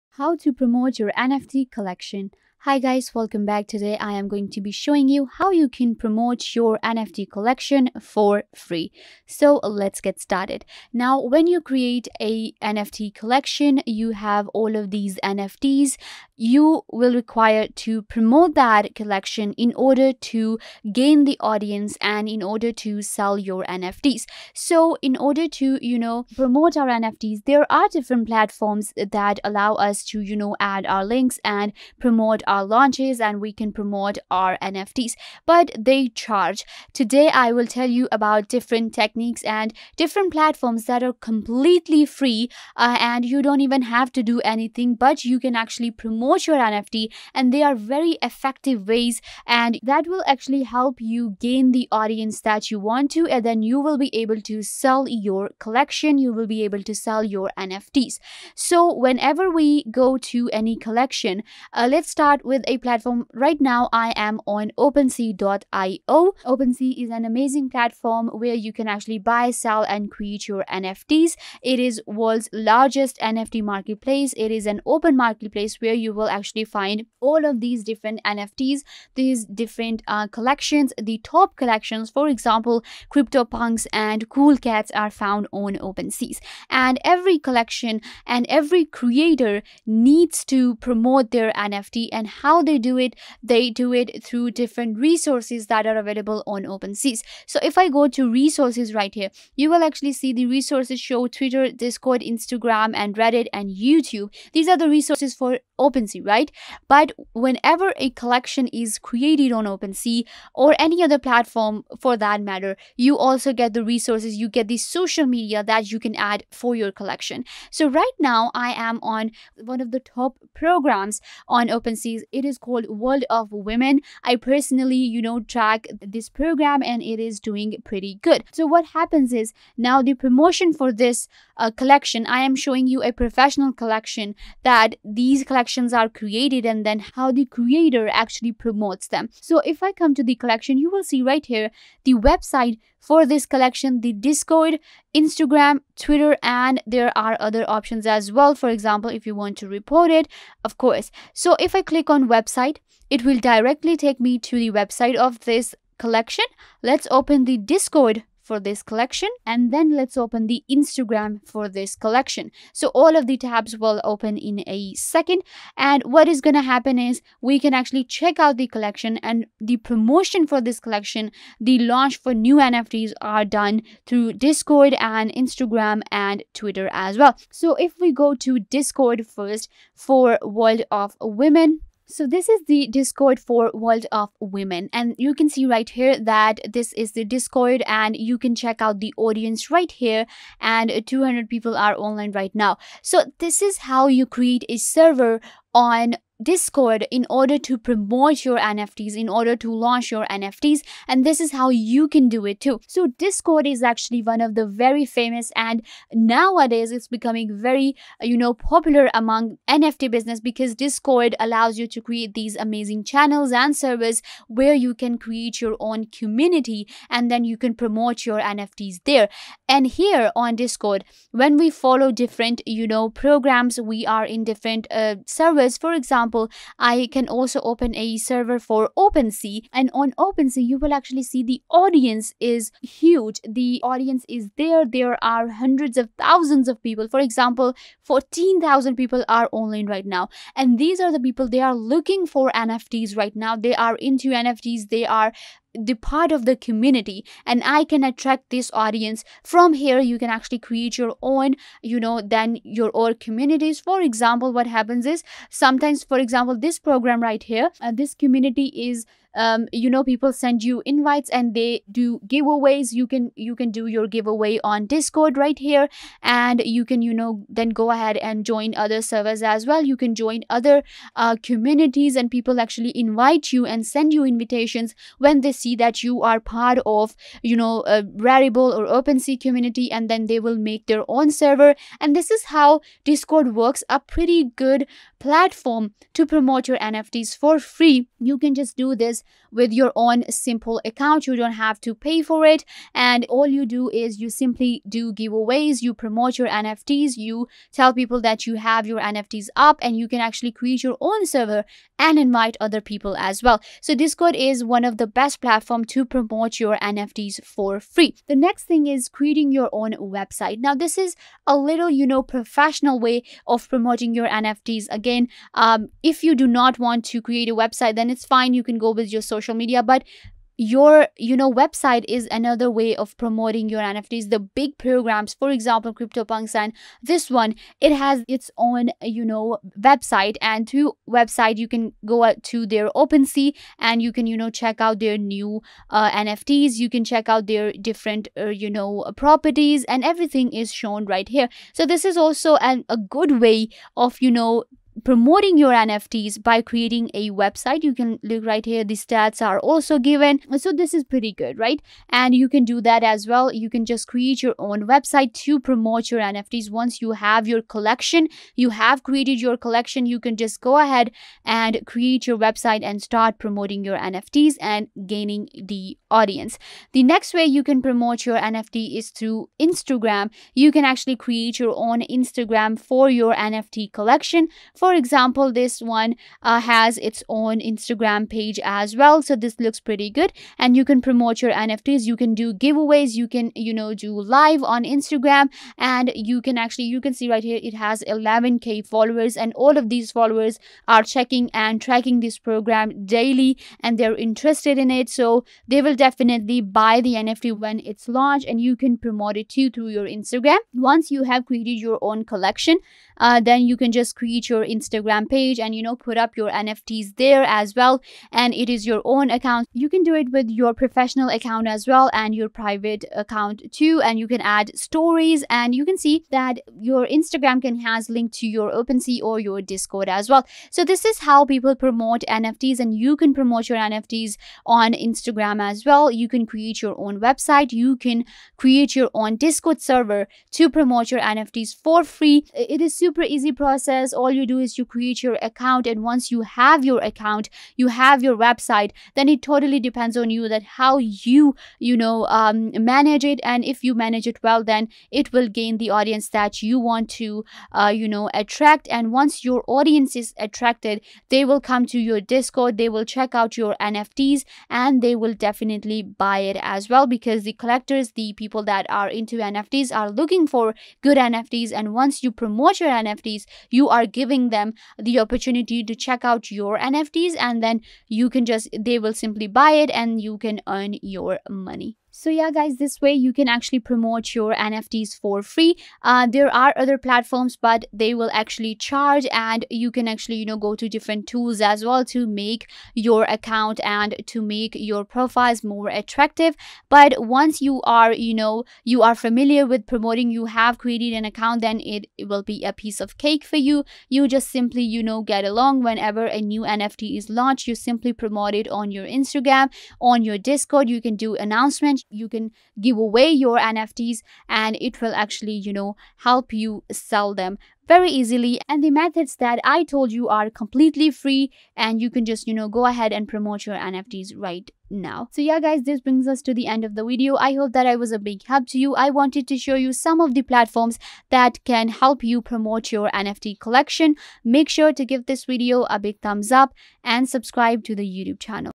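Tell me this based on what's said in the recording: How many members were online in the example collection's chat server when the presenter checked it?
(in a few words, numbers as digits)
200.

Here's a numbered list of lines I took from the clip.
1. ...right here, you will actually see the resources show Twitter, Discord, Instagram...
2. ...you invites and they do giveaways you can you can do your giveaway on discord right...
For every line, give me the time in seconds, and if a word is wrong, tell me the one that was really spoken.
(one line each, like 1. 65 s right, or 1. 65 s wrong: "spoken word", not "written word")
1. 98 s right
2. 260 s right.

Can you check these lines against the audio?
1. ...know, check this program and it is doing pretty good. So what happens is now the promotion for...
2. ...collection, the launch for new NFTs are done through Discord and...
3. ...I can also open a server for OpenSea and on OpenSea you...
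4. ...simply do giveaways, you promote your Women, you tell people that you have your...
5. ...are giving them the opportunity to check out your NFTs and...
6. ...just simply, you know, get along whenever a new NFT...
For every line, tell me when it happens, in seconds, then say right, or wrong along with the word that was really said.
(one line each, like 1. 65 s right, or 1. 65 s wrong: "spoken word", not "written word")
1. 125 s wrong: "track", not "check"
2. 170 s right
3. 226 s right
4. 294 s wrong: "NFTs", not "Women"
5. 463 s right
6. 494 s right.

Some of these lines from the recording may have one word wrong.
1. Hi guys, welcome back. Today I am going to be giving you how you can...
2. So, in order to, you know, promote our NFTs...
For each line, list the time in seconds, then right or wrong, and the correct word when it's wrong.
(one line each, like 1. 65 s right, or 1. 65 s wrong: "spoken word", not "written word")
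1. 2 s wrong: "showing", not "giving"
2. 24 s right.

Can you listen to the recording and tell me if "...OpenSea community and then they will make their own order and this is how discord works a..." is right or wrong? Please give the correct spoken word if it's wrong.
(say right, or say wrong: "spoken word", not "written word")
wrong: "server", not "order".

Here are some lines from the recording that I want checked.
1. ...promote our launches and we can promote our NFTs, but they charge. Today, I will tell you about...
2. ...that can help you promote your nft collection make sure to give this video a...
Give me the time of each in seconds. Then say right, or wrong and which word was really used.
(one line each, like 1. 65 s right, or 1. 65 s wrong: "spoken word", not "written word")
1. 31 s right
2. 521 s right.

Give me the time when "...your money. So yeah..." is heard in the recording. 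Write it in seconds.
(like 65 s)
471 s.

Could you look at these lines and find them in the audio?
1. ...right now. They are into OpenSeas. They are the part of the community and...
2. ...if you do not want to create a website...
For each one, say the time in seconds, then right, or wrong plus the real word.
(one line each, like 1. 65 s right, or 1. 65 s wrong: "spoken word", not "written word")
1. 243 s wrong: "NFTs", not "OpenSeas"
2. 316 s right.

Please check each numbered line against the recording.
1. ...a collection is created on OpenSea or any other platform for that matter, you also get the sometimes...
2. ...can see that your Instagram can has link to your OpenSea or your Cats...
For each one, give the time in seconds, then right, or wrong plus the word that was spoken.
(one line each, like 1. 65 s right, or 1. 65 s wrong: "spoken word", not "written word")
1. 107 s wrong: "resources", not "sometimes"
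2. 415 s wrong: "Discord", not "Cats".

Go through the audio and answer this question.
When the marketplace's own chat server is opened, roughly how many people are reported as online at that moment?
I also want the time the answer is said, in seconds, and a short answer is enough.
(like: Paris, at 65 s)
14,000, at 238 s.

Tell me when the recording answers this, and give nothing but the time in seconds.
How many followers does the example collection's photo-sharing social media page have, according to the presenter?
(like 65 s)
388 s.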